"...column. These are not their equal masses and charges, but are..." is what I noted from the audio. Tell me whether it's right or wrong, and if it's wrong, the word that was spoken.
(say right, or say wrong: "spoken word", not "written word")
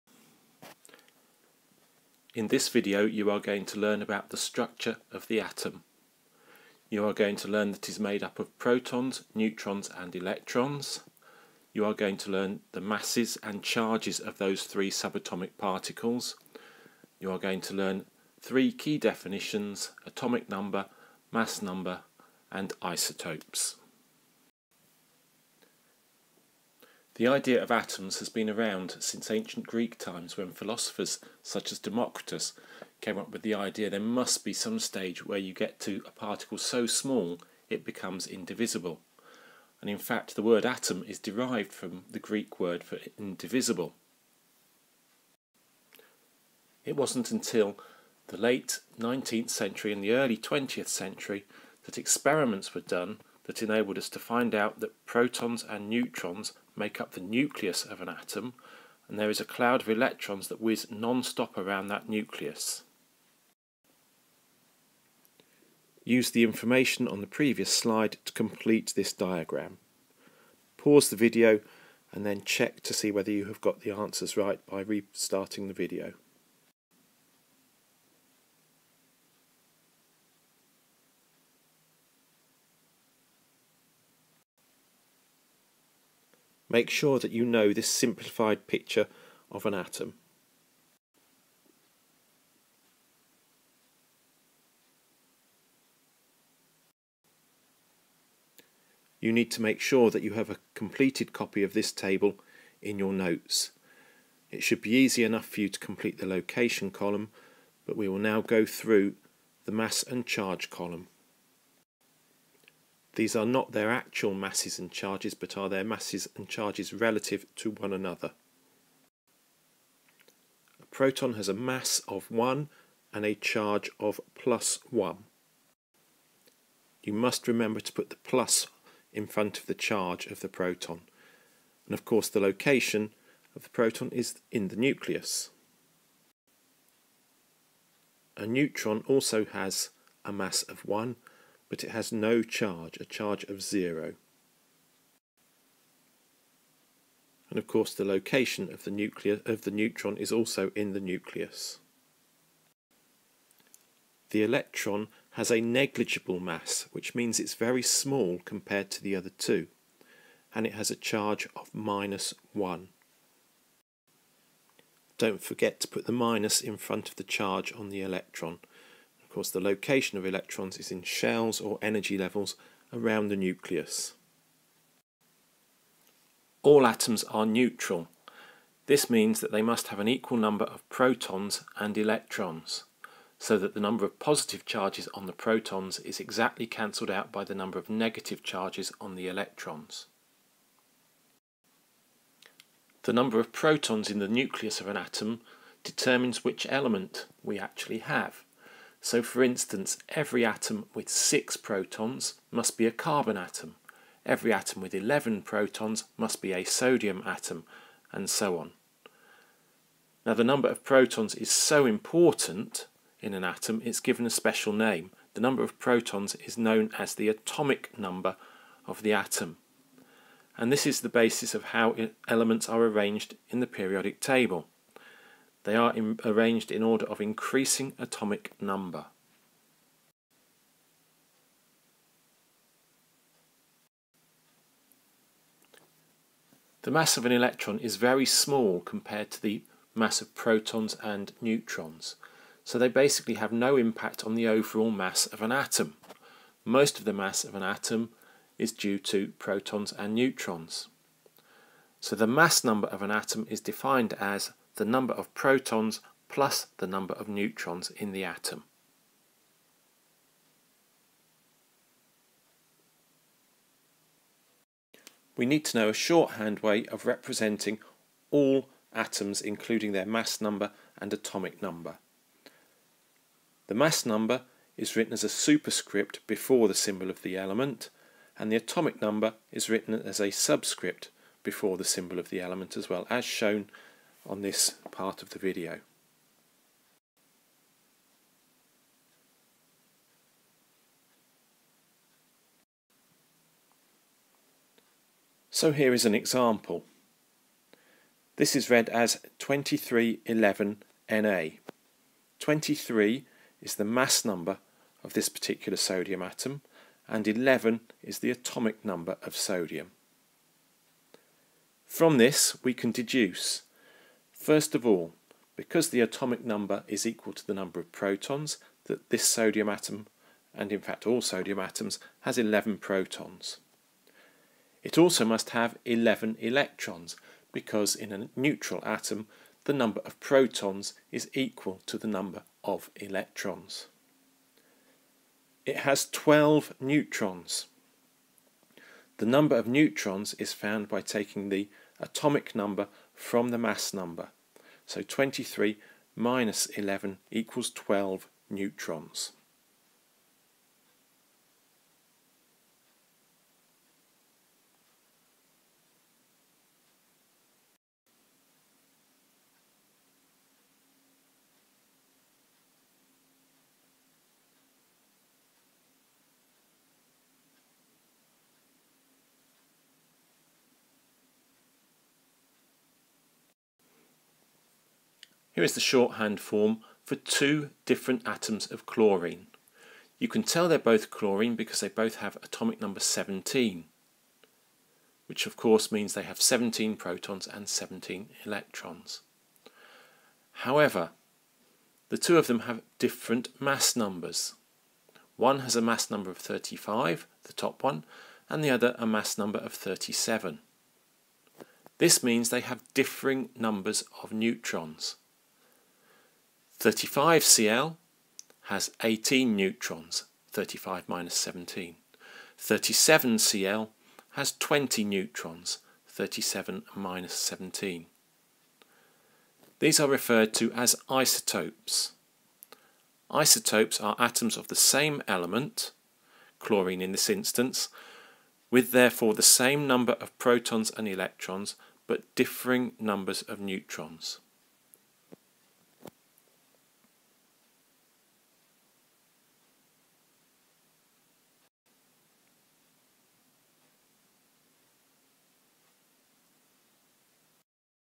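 wrong: "actual", not "equal".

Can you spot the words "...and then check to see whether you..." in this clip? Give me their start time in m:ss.
1:12.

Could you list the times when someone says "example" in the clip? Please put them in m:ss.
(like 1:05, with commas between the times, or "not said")
4:56.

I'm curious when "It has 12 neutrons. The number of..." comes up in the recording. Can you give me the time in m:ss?
5:35.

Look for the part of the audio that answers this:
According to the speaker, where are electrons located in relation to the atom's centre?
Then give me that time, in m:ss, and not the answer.
2:51.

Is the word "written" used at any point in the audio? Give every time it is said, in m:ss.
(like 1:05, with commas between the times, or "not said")
4:34, 4:39.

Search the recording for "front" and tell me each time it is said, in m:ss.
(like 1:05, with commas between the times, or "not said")
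2:09, 2:46.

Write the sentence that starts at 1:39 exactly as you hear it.
You need to make sure that you have a completed copy of this table in your notes.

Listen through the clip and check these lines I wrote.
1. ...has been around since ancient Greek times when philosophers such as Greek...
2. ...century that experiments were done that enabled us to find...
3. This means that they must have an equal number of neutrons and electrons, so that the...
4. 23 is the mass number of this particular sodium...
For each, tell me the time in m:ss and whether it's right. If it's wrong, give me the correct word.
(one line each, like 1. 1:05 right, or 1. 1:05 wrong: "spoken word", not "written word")
1. 0:28 wrong: "Democritus", not "Greek"
2. 0:50 right
3. 2:58 wrong: "protons", not "neutrons"
4. 5:02 right.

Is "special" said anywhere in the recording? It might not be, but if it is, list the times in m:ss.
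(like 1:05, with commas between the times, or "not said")
3:34.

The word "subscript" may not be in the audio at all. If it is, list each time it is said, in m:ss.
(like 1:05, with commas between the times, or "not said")
4:40.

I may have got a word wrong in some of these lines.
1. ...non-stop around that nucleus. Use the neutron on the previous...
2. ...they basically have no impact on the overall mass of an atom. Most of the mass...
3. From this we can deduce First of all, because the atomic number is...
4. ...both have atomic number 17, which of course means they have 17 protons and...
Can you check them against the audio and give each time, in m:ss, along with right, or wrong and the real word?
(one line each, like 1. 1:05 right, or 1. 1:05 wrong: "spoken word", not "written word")
1. 1:00 wrong: "information", not "neutron"
2. 4:02 right
3. 5:11 right
4. 6:21 right.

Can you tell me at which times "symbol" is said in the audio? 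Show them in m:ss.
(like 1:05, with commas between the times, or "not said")
4:36, 4:41.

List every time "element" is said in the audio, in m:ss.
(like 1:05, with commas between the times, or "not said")
3:16, 3:42, 4:37, 4:42, 7:05.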